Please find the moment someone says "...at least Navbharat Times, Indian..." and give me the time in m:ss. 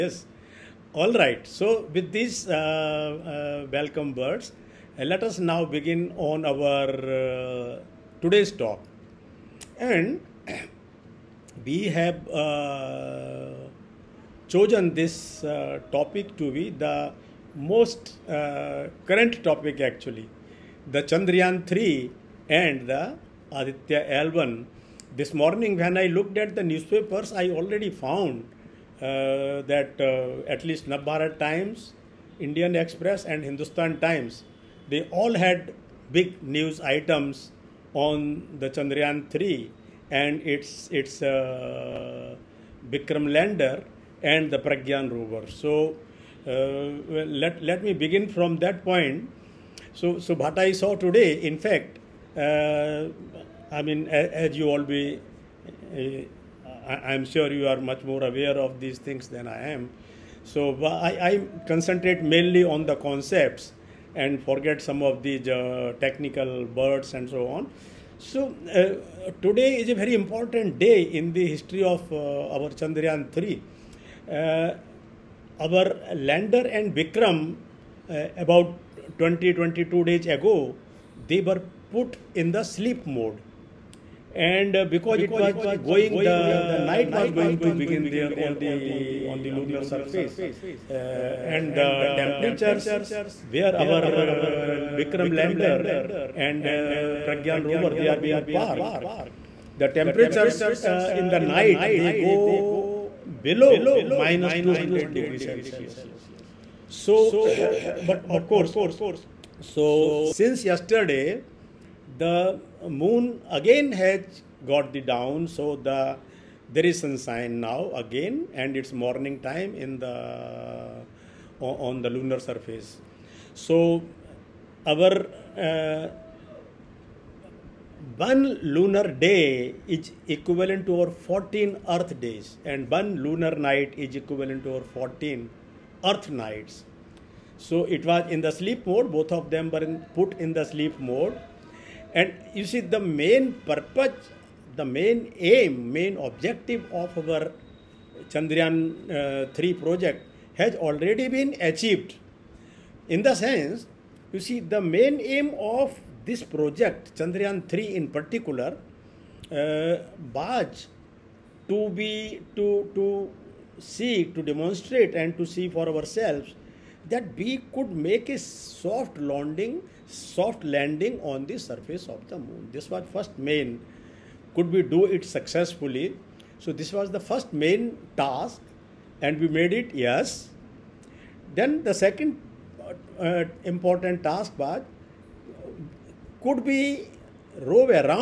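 0:30.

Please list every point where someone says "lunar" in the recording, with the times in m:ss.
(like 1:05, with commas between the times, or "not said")
1:29, 2:02, 2:08, 2:13.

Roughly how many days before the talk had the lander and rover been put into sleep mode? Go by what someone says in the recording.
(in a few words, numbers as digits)
22 days.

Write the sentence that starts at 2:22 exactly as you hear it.
And you see, the main purpose, the main aim, main objective of our Chandrayaan uh, 3 project has already been achieved.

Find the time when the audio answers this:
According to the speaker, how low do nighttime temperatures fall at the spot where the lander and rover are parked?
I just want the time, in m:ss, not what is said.
1:44.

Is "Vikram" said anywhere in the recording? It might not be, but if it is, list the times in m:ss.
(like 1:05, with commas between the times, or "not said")
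0:42, 1:16, 1:34.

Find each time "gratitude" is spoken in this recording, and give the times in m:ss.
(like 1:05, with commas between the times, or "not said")
not said.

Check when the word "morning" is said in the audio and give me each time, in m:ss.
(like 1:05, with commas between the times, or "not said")
0:25, 1:58.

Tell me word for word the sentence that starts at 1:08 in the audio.
So uh, today is a very important day in the history of uh, our Chandrayaan 3.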